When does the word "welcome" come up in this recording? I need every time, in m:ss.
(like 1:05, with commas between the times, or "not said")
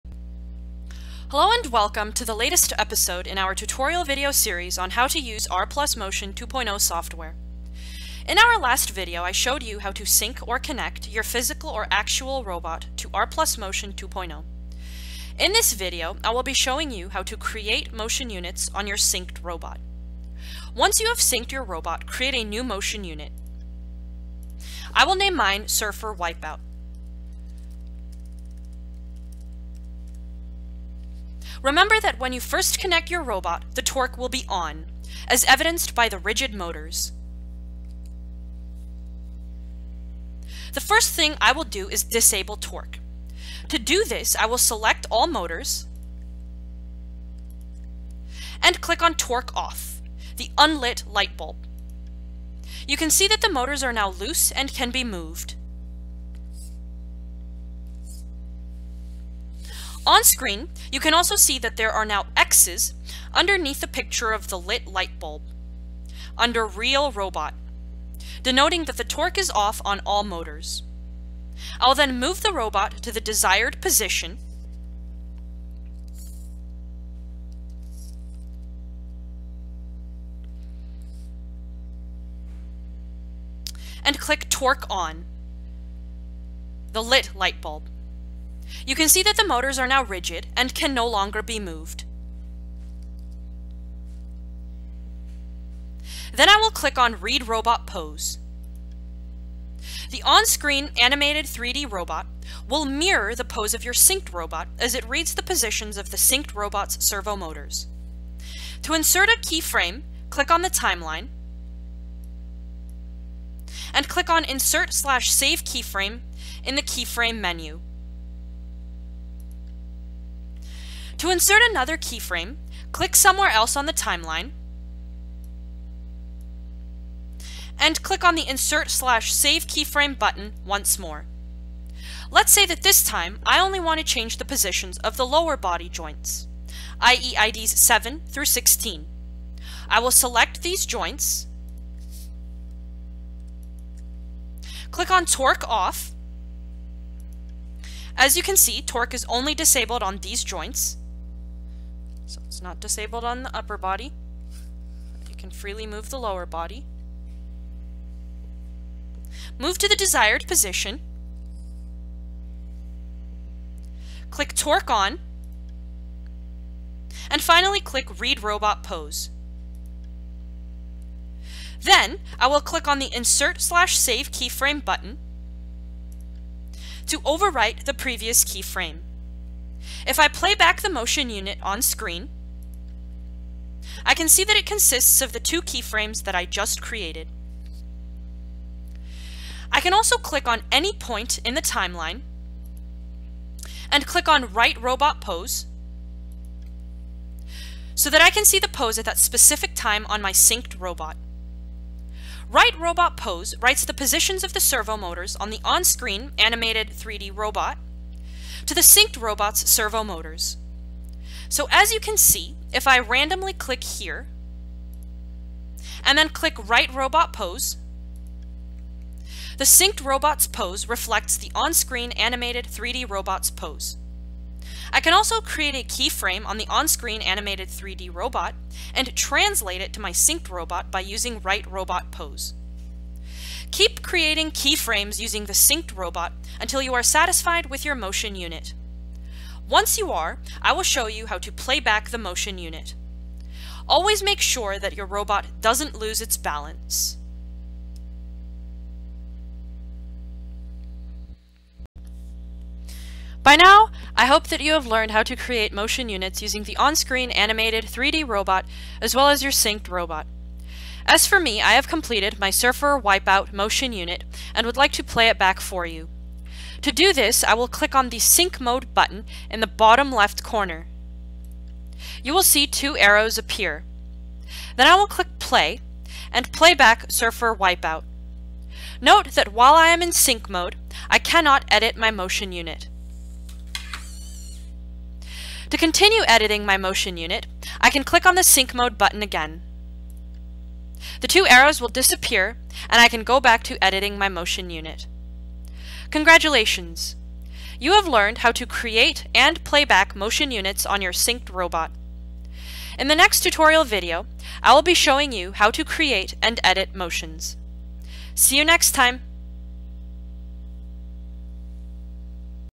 0:01.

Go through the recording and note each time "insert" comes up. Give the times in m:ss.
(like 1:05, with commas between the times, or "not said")
1:48, 1:54, 2:01, 2:08, 2:53.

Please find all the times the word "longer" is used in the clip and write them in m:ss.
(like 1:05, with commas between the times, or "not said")
1:31.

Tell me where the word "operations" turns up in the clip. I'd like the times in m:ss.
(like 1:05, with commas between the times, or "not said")
not said.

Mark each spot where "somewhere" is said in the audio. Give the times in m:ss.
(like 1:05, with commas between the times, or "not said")
2:03.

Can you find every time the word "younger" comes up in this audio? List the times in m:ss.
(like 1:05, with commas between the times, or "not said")
not said.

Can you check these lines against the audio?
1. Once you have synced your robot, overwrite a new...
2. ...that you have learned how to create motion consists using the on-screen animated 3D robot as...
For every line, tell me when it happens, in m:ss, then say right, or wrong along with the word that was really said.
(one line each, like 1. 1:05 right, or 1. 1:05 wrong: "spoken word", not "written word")
1. 0:20 wrong: "create", not "overwrite"
2. 4:14 wrong: "units", not "consists".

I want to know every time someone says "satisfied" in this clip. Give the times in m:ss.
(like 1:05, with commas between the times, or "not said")
3:57.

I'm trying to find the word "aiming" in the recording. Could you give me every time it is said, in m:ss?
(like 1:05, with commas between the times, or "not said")
not said.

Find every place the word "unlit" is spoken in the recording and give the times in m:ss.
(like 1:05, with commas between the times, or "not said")
0:50.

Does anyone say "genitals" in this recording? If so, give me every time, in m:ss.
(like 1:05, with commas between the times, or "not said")
not said.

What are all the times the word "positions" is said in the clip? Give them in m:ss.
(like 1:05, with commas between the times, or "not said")
1:13, 1:45, 2:14, 2:40, 3:23.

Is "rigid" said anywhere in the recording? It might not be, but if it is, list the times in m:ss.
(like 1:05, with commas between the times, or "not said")
0:36, 1:30.